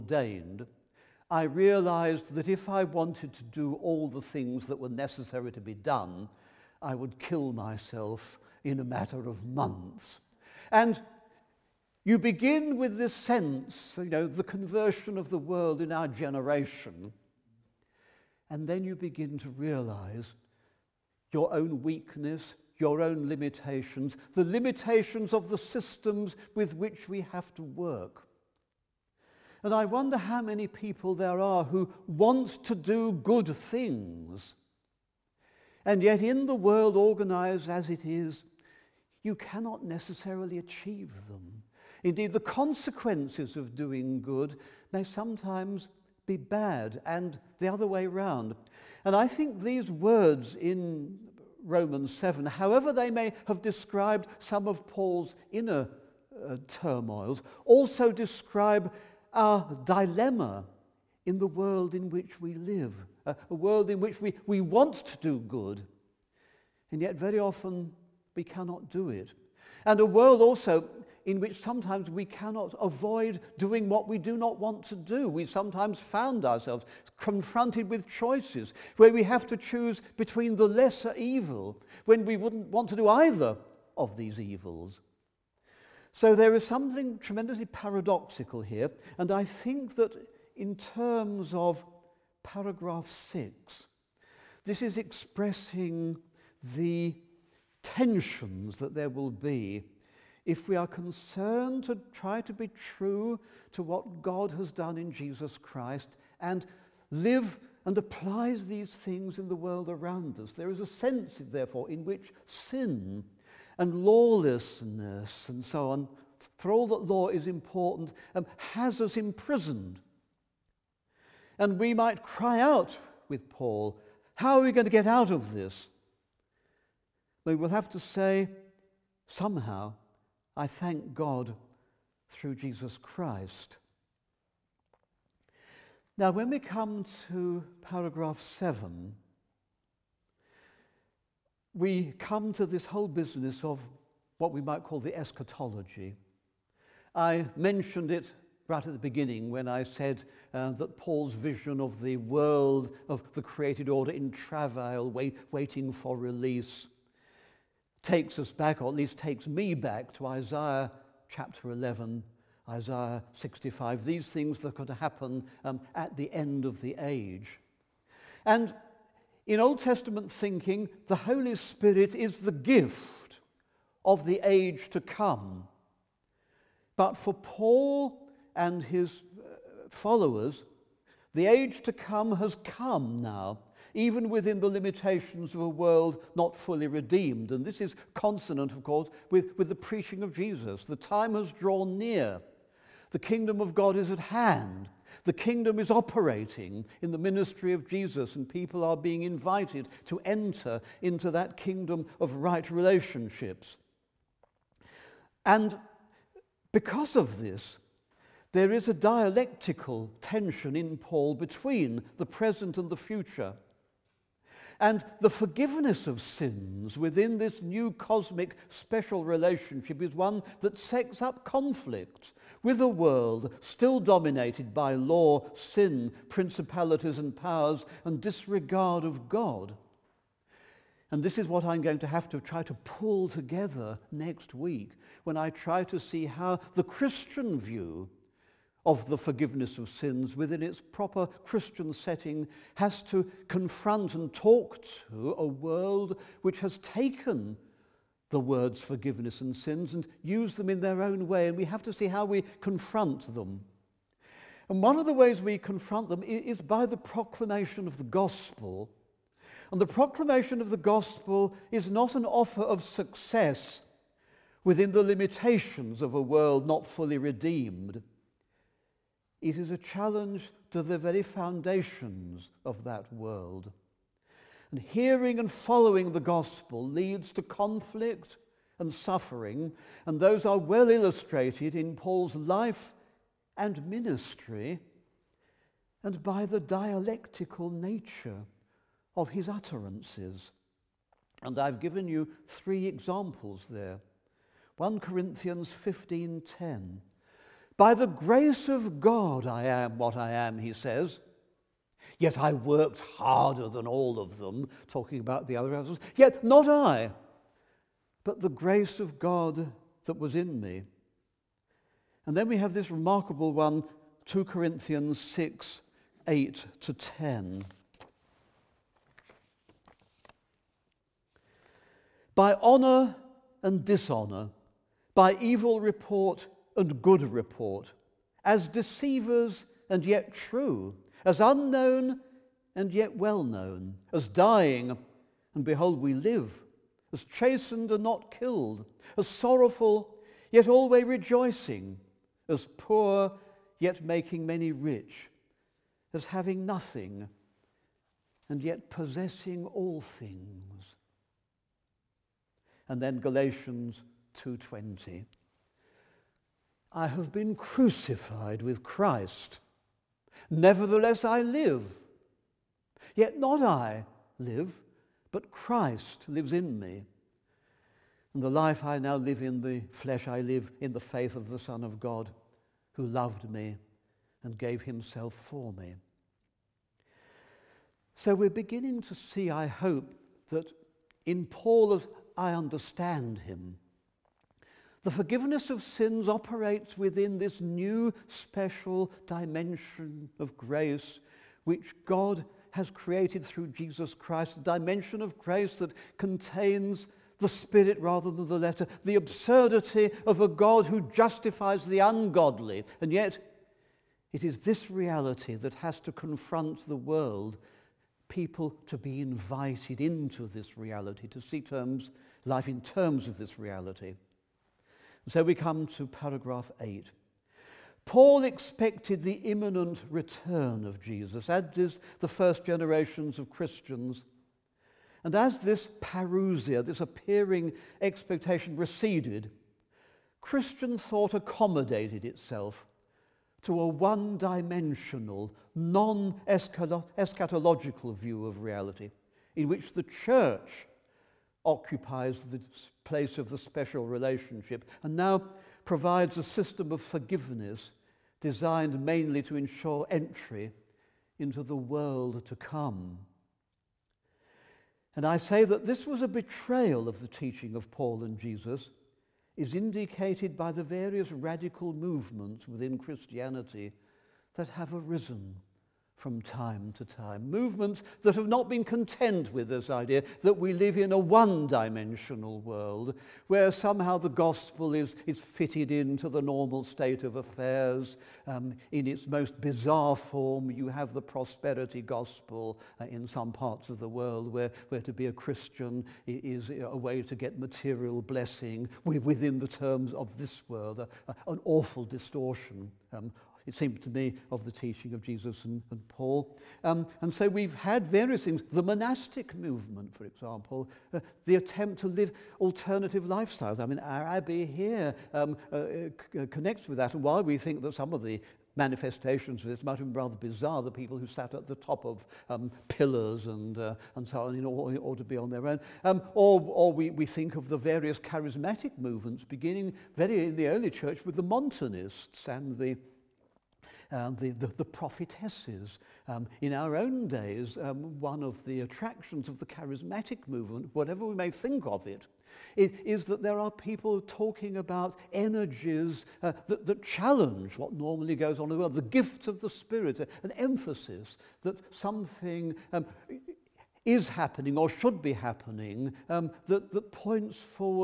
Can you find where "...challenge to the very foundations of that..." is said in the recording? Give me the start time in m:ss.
4:29.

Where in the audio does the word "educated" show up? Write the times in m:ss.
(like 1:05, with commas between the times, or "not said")
not said.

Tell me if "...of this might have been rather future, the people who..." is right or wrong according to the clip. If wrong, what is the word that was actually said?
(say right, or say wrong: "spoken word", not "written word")
wrong: "bizarre", not "future".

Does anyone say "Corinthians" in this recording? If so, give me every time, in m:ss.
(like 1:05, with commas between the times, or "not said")
4:54, 5:14.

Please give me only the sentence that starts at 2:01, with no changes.
And we might cry out with Paul, How are we going to get out of this?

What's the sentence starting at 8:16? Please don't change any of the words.
Um, and so we've had various things.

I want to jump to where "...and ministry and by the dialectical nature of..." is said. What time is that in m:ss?
4:43.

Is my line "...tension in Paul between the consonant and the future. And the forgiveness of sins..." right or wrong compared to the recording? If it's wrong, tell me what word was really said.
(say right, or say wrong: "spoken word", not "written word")
wrong: "present", not "consonant".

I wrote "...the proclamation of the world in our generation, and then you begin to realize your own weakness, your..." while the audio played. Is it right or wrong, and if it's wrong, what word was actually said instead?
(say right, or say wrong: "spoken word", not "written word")
wrong: "conversion", not "proclamation".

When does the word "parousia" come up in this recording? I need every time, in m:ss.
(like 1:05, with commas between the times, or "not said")
7:06.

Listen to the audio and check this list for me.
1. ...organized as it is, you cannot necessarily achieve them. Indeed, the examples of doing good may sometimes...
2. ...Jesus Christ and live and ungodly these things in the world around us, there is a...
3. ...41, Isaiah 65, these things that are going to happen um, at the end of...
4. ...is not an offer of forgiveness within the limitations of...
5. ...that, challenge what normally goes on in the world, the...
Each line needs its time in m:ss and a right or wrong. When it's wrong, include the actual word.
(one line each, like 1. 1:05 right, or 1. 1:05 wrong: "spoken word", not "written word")
1. 0:36 wrong: "consequences", not "examples"
2. 1:45 wrong: "apply", not "ungodly"
3. 2:41 wrong: "11", not "41"
4. 4:21 wrong: "success", not "forgiveness"
5. 8:56 right.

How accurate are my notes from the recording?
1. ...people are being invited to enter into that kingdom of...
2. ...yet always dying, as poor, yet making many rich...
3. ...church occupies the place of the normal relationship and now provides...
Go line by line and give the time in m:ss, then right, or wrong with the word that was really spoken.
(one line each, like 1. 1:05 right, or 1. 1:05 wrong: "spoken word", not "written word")
1. 3:18 right
2. 5:40 wrong: "rejoicing", not "dying"
3. 7:20 wrong: "special", not "normal".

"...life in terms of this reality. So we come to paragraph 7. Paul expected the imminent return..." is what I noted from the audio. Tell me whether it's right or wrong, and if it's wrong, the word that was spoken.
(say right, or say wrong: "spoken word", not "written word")
wrong: "8", not "7".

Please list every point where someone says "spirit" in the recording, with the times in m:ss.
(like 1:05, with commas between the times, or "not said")
2:51, 6:37, 8:59.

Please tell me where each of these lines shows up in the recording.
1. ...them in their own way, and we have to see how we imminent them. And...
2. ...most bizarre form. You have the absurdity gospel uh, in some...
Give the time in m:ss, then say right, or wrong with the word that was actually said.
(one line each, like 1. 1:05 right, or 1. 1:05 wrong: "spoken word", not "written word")
1. 4:10 wrong: "confront", not "imminent"
2. 7:59 wrong: "prosperity", not "absurdity".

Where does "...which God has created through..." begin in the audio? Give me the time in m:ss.
6:31.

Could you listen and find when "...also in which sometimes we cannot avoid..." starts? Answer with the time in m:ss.
1:10.